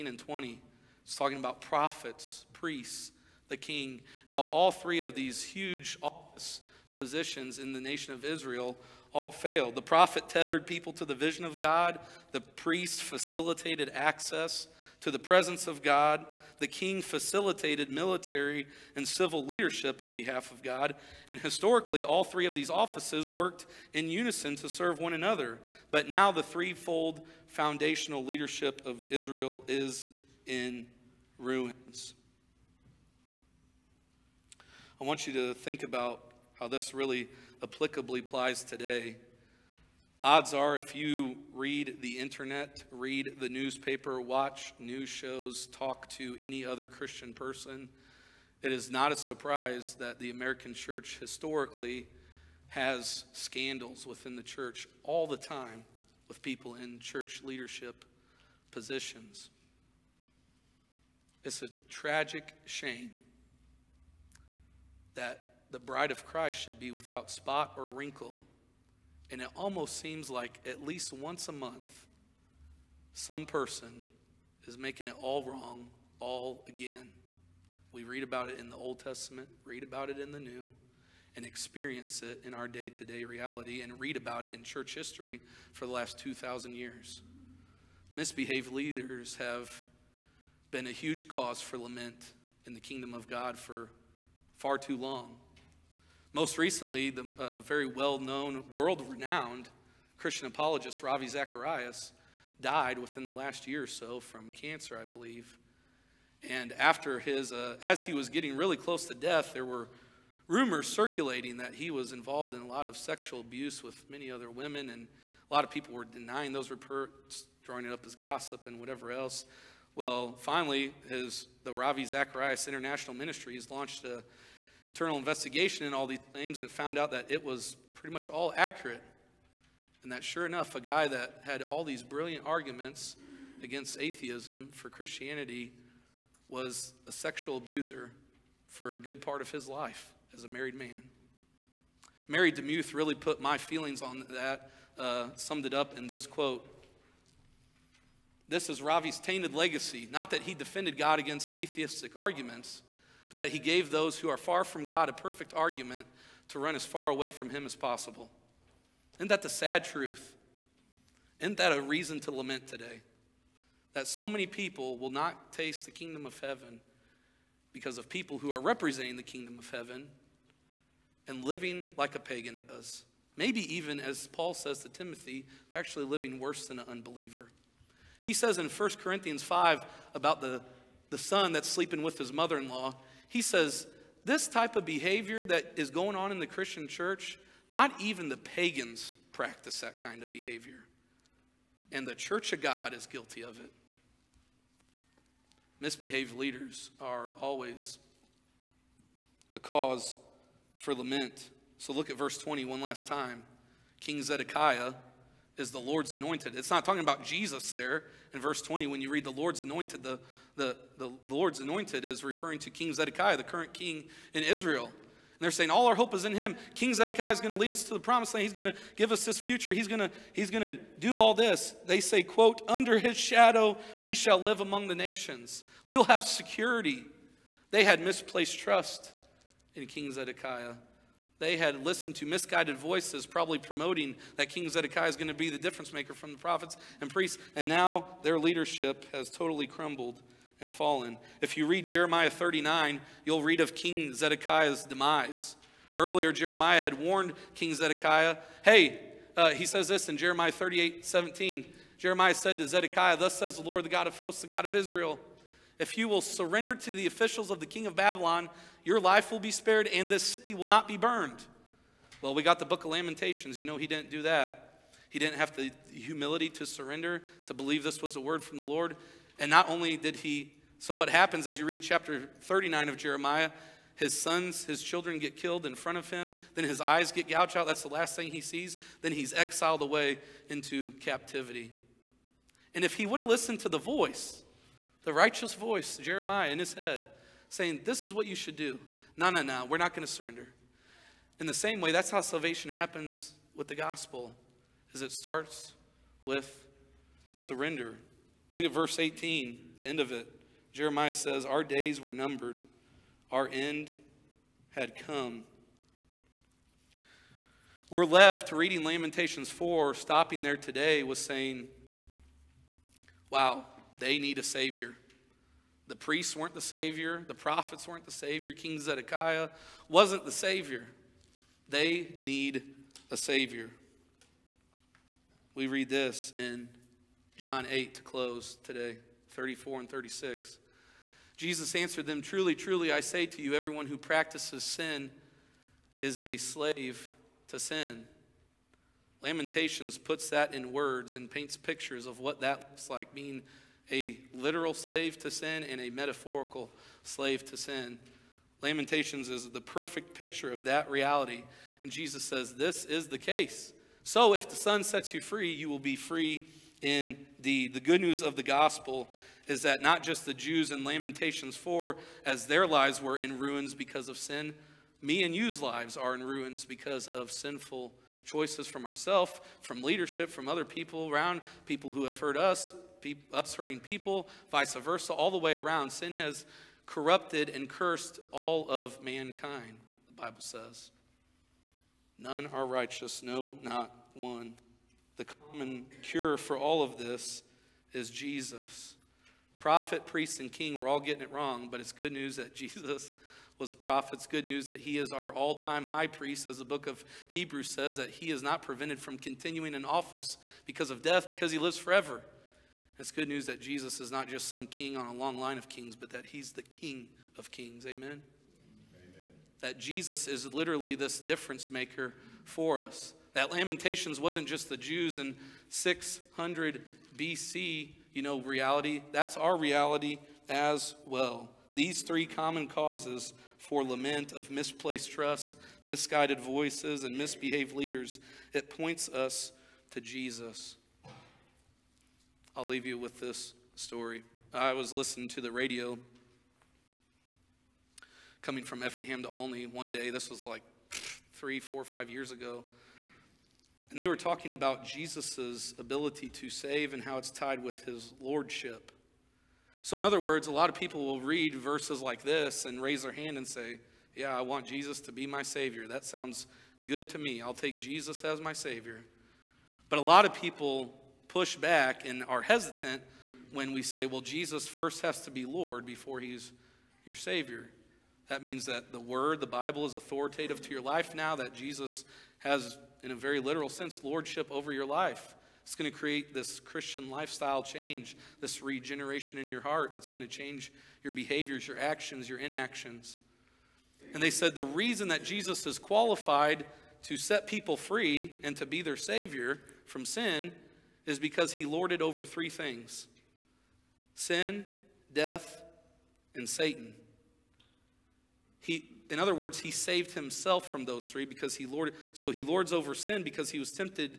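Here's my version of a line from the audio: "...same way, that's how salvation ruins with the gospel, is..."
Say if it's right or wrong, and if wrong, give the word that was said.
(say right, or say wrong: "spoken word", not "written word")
wrong: "happens", not "ruins".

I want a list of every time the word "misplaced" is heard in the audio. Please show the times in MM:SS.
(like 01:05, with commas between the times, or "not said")
03:48, 07:04.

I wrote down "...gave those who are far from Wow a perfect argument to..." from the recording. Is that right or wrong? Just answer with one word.
wrong.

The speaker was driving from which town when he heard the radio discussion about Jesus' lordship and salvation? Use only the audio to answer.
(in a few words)
Effingham.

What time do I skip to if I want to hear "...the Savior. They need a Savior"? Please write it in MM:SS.
05:20.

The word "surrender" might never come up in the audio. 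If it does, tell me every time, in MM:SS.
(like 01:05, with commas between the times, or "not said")
04:16, 04:26, 04:50, 04:57.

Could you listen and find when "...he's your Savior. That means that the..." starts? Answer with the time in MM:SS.
07:46.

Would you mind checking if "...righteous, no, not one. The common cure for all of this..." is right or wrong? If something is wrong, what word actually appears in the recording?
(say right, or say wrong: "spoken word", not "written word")
right.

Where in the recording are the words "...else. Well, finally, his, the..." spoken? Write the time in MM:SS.
01:59.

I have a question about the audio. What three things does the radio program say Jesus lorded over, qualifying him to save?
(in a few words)
Sin, death, and Satan.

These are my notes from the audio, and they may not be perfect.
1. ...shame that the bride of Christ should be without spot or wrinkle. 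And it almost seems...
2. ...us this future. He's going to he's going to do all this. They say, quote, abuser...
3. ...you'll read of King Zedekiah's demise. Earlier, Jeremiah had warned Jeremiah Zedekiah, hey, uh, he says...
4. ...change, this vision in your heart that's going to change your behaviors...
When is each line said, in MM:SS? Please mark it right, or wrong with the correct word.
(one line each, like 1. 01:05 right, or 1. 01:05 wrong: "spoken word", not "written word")
1. 01:02 right
2. 03:39 wrong: "under", not "abuser"
3. 04:03 wrong: "King", not "Jeremiah"
4. 07:57 wrong: "regeneration", not "vision".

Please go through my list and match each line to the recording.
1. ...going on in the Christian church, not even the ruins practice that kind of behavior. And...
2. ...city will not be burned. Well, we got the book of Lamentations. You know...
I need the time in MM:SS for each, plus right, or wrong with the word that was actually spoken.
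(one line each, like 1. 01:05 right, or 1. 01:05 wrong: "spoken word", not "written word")
1. 03:05 wrong: "pagans", not "ruins"
2. 04:20 right.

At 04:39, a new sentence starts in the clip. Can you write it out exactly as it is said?
Then he's exiled away into captivity.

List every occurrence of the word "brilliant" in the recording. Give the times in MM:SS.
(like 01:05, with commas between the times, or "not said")
02:12.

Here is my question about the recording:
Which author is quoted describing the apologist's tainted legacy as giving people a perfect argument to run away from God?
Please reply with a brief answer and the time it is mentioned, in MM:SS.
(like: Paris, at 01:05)
Mary DeMuth, at 02:22.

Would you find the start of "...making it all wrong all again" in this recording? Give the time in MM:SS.
01:14.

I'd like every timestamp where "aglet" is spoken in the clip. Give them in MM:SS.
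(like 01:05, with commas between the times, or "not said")
not said.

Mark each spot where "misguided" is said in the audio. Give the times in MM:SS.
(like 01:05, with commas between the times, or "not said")
03:52, 07:05.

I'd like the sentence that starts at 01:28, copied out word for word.
Misbehaved leaders have been a huge cause for lament in the kingdom of God for far too long.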